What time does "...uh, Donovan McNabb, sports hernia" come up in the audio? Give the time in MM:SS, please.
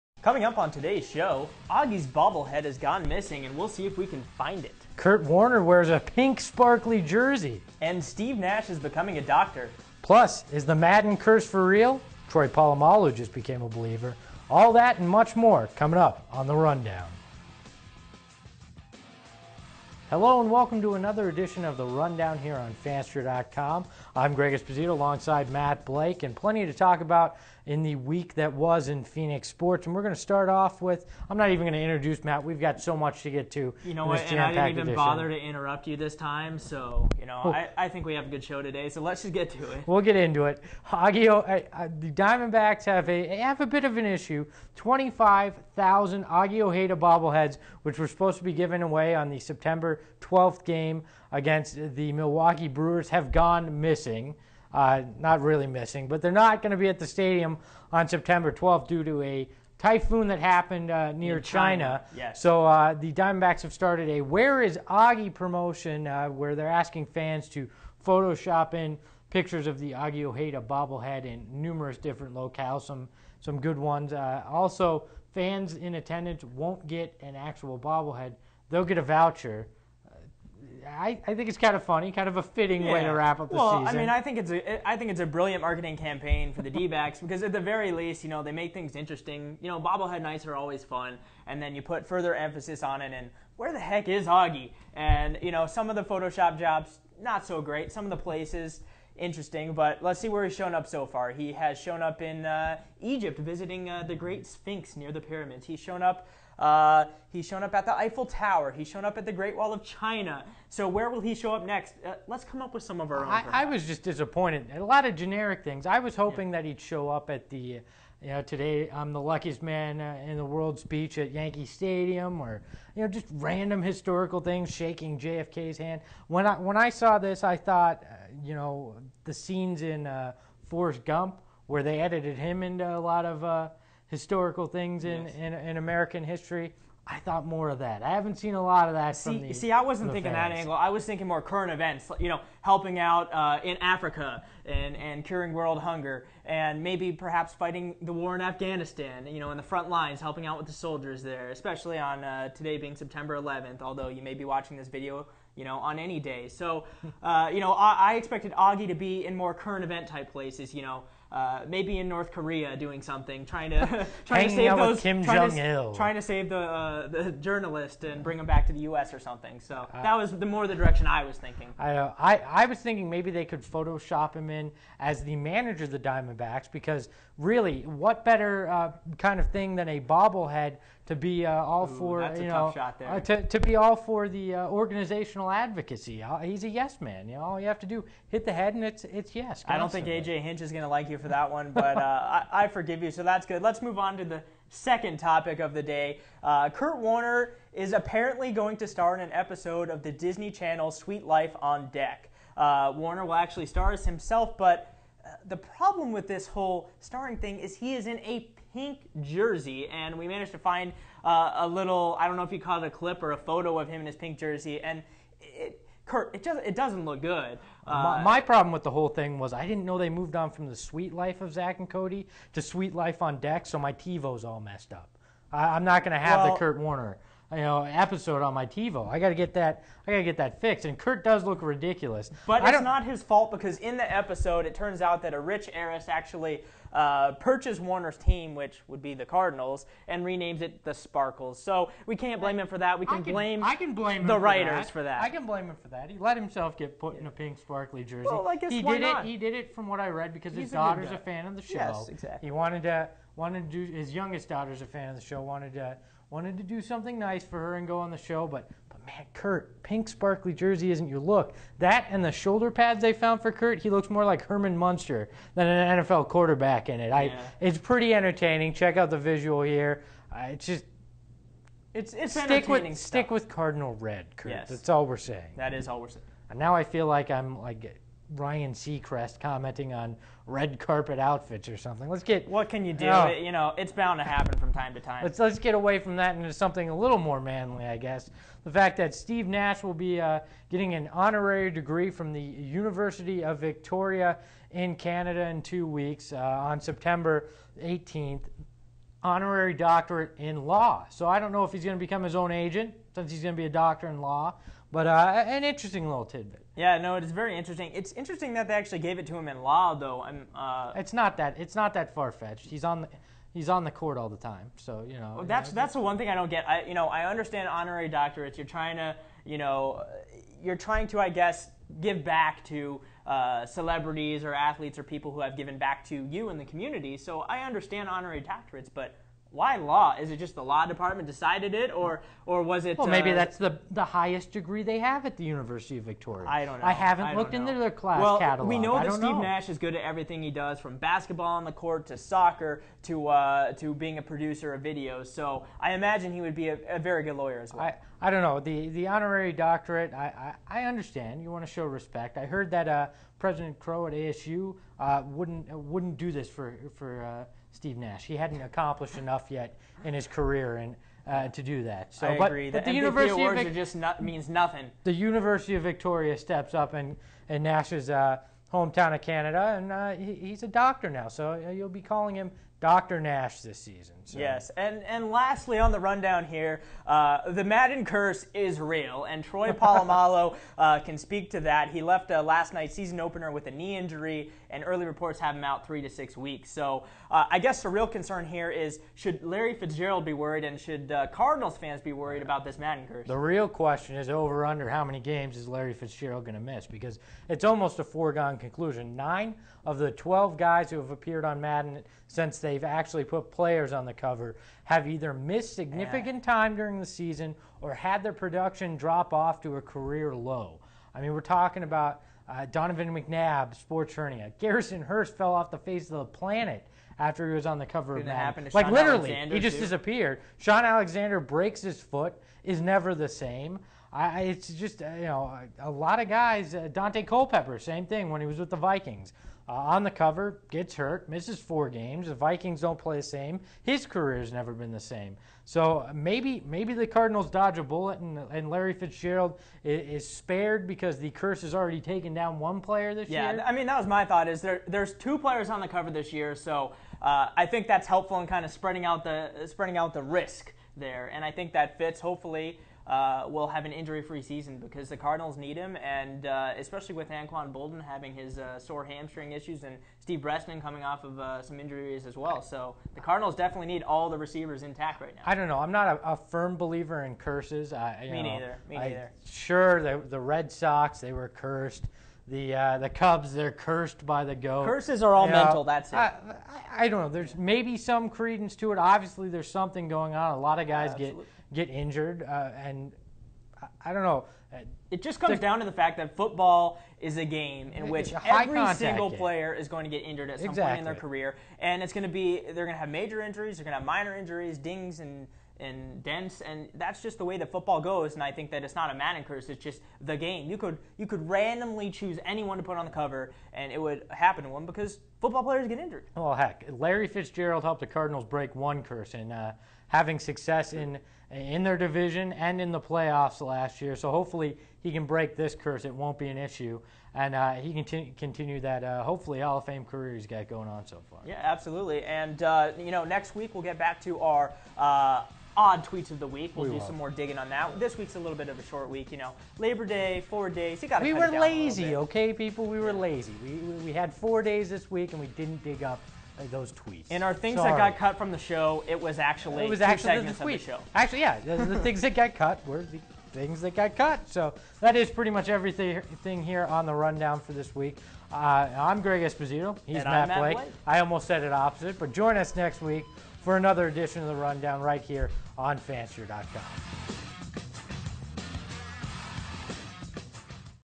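06:52.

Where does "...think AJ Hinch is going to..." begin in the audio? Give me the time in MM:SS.
03:09.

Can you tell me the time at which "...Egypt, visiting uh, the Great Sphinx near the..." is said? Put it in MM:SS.
01:42.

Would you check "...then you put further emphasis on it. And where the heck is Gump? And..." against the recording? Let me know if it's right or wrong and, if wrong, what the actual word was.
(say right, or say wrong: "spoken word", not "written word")
wrong: "Augie", not "Gump".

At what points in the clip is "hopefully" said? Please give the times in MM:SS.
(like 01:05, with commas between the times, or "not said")
07:32, 08:34, 08:39.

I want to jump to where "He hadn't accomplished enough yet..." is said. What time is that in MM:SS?
05:58.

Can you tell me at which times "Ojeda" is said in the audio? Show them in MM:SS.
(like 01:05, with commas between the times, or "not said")
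00:46, 01:10.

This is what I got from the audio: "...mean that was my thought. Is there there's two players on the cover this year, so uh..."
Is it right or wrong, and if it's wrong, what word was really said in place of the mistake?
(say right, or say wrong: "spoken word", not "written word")
right.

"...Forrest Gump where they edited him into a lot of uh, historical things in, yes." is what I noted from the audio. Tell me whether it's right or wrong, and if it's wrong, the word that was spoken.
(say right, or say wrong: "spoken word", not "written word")
right.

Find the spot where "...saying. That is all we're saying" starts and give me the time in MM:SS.
04:35.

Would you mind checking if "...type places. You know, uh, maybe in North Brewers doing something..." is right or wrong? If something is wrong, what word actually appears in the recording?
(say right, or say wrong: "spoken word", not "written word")
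wrong: "Korea", not "Brewers".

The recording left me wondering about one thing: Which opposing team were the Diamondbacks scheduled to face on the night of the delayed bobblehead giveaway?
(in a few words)
Milwaukee Brewers.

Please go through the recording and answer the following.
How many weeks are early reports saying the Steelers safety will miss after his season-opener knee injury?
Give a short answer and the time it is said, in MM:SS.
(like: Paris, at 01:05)
3 to 6 weeks, at 06:25.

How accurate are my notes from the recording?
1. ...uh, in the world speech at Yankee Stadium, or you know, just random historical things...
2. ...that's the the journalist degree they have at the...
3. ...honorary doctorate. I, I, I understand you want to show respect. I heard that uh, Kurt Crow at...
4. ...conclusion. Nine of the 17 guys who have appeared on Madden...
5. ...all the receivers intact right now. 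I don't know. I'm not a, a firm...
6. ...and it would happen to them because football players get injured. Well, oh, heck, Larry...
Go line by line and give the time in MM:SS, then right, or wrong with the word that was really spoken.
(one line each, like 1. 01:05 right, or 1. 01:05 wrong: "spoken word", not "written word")
1. 01:59 right
2. 05:33 wrong: "highest", not "journalist"
3. 05:49 wrong: "President", not "Kurt"
4. 06:38 wrong: "12", not "17"
5. 07:44 right
6. 08:23 right.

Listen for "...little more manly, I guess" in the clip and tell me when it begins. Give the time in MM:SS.
04:46.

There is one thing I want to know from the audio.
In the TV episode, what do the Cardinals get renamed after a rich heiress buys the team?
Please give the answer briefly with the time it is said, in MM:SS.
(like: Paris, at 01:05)
The Sparkles, at 04:00.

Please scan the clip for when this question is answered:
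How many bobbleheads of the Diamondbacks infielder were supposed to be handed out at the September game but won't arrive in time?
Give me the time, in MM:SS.
00:44.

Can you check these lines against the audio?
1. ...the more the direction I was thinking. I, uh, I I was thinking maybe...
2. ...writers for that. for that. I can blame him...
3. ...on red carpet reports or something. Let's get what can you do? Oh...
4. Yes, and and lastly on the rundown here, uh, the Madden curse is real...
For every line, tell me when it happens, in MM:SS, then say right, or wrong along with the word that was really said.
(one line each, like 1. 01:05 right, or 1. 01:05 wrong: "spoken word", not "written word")
1. 02:50 right
2. 04:04 right
3. 04:39 wrong: "outfits", not "reports"
4. 06:14 right.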